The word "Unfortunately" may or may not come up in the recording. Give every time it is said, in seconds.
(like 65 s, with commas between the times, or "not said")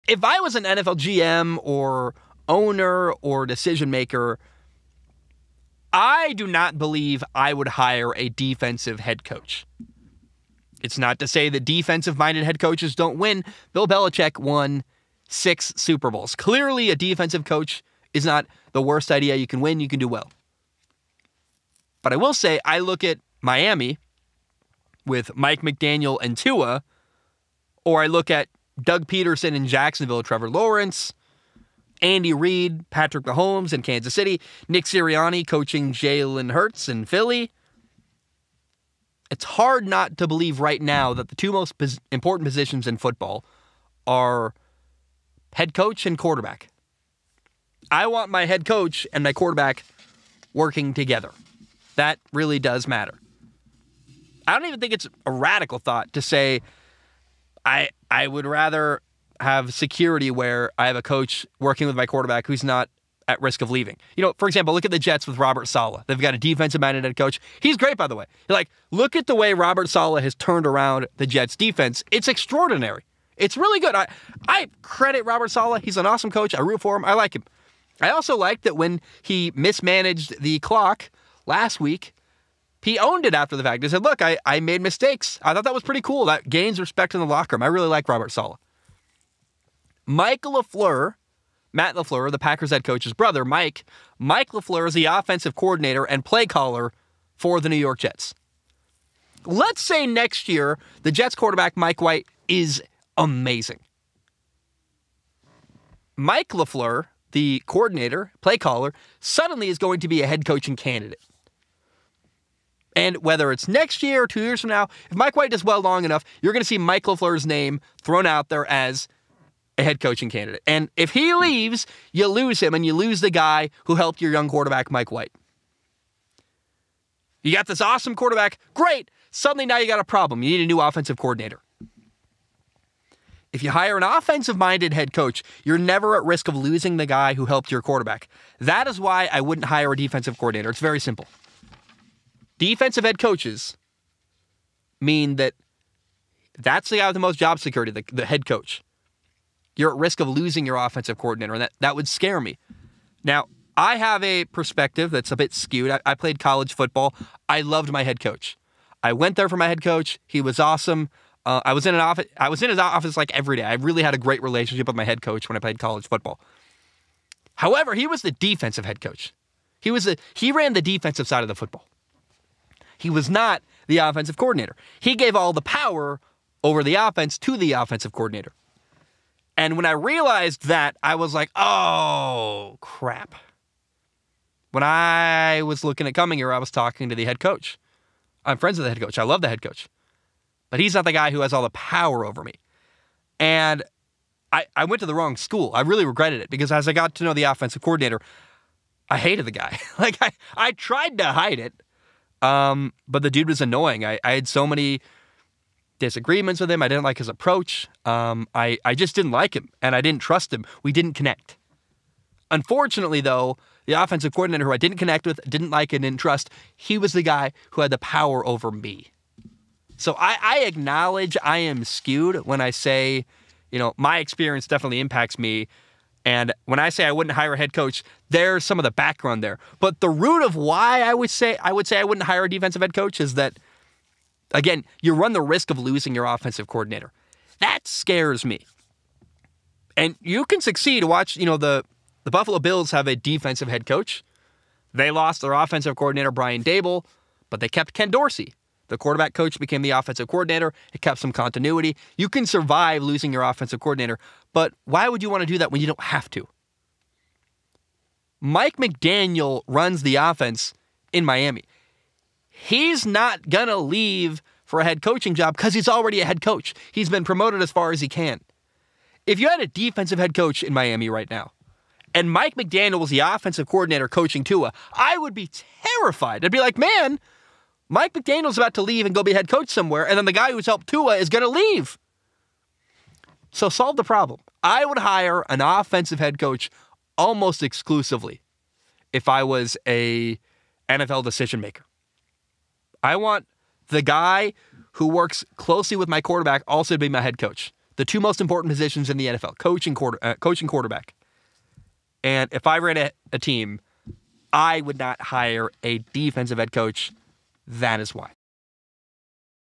212 s.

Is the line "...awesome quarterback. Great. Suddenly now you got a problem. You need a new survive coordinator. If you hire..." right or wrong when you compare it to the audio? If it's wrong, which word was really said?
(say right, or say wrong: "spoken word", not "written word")
wrong: "offensive", not "survive".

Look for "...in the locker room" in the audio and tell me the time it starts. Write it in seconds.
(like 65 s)
87 s.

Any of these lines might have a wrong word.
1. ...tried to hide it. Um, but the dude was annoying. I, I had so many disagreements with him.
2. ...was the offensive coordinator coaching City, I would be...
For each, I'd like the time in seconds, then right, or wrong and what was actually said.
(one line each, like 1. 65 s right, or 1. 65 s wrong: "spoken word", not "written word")
1. 200 s right
2. 272 s wrong: "Tua", not "City".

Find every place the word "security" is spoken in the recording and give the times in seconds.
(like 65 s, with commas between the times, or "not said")
59 s, 147 s.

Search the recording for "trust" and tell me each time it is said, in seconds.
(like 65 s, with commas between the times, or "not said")
210 s, 216 s.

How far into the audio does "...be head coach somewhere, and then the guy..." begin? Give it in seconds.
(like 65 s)
279 s.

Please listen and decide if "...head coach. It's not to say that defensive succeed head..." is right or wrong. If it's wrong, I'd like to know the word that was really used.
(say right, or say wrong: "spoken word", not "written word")
wrong: "minded", not "succeed".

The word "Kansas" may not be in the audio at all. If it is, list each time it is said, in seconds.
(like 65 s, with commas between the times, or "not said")
33 s.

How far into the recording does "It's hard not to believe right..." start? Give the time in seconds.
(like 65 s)
39 s.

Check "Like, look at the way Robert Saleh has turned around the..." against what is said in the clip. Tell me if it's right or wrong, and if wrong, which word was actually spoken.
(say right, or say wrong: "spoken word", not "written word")
right.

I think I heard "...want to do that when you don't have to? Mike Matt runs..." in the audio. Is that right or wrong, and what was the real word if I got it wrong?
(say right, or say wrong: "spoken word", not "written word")
wrong: "McDaniel", not "Matt".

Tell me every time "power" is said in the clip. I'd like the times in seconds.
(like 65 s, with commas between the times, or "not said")
175 s, 191 s, 217 s.